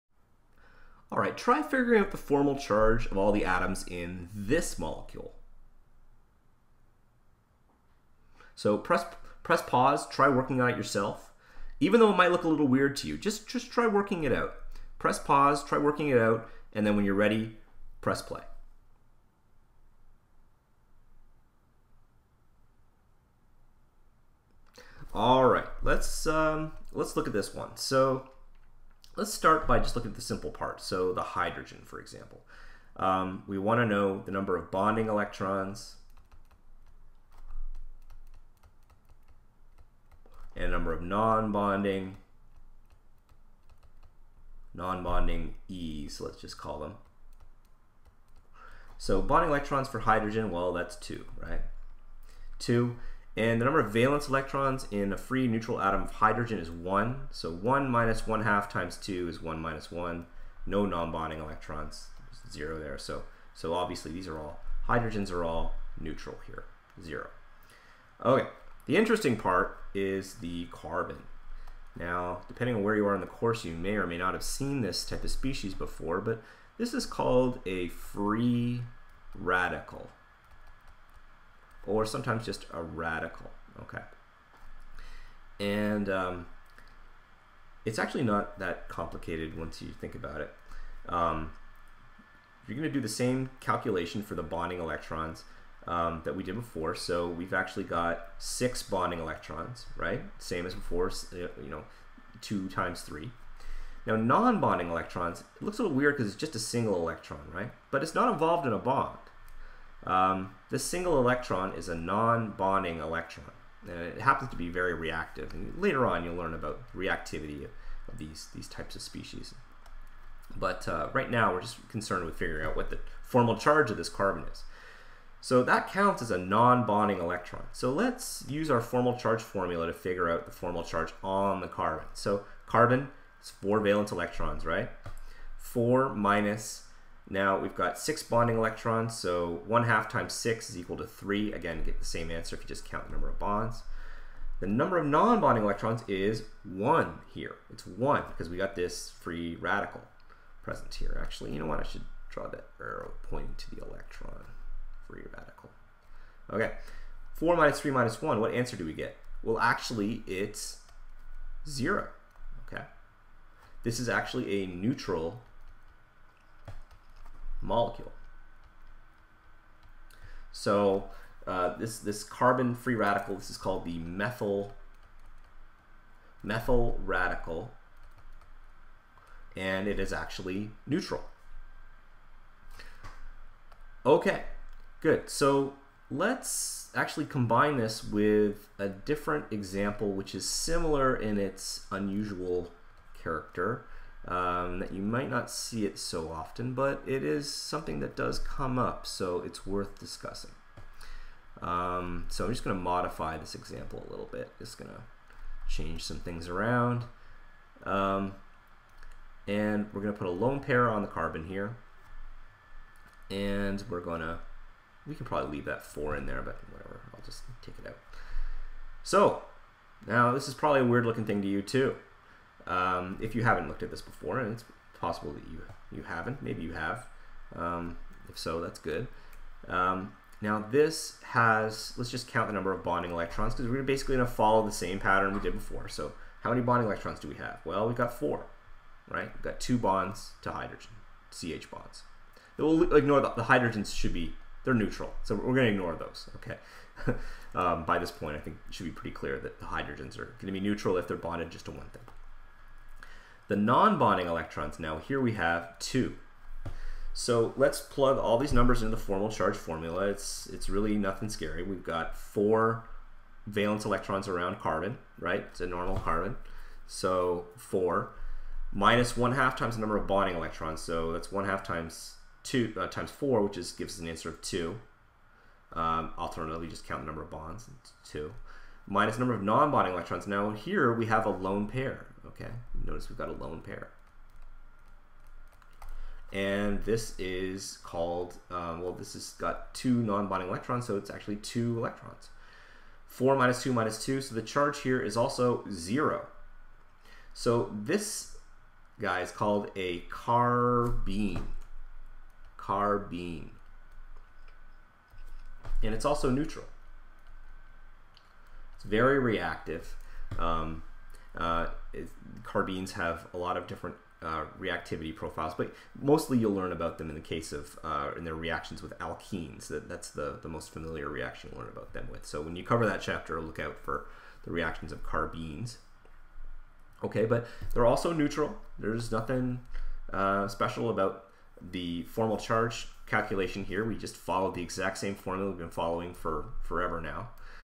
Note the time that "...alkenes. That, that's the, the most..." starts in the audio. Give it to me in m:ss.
5:18.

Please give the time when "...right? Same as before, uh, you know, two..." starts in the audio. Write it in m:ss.
1:39.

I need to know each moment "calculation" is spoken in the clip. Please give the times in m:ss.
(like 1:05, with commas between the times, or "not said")
1:33, 5:33.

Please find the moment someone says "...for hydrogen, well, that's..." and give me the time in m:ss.
0:49.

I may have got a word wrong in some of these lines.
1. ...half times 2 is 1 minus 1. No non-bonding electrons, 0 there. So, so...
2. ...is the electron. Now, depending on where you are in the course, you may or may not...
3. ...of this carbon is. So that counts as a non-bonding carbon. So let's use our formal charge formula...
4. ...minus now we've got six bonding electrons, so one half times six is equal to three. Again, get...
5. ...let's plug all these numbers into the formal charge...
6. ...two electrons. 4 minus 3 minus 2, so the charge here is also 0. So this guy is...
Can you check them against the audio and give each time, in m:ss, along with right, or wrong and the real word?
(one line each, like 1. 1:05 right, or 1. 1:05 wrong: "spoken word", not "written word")
1. 0:58 right
2. 1:09 wrong: "carbon", not "electron"
3. 2:03 wrong: "electron", not "carbon"
4. 2:16 right
5. 4:17 right
6. 4:51 wrong: "2", not "3".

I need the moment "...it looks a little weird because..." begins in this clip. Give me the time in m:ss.
1:45.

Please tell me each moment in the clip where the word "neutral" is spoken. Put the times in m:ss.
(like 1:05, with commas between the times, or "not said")
0:55, 1:05, 2:44, 3:00, 4:04, 4:10, 5:06, 5:28.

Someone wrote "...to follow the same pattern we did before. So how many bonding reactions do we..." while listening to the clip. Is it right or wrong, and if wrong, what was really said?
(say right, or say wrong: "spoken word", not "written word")
wrong: "electrons", not "reactions".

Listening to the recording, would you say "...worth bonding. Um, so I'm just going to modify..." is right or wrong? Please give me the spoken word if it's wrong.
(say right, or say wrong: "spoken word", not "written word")
wrong: "discussing", not "bonding".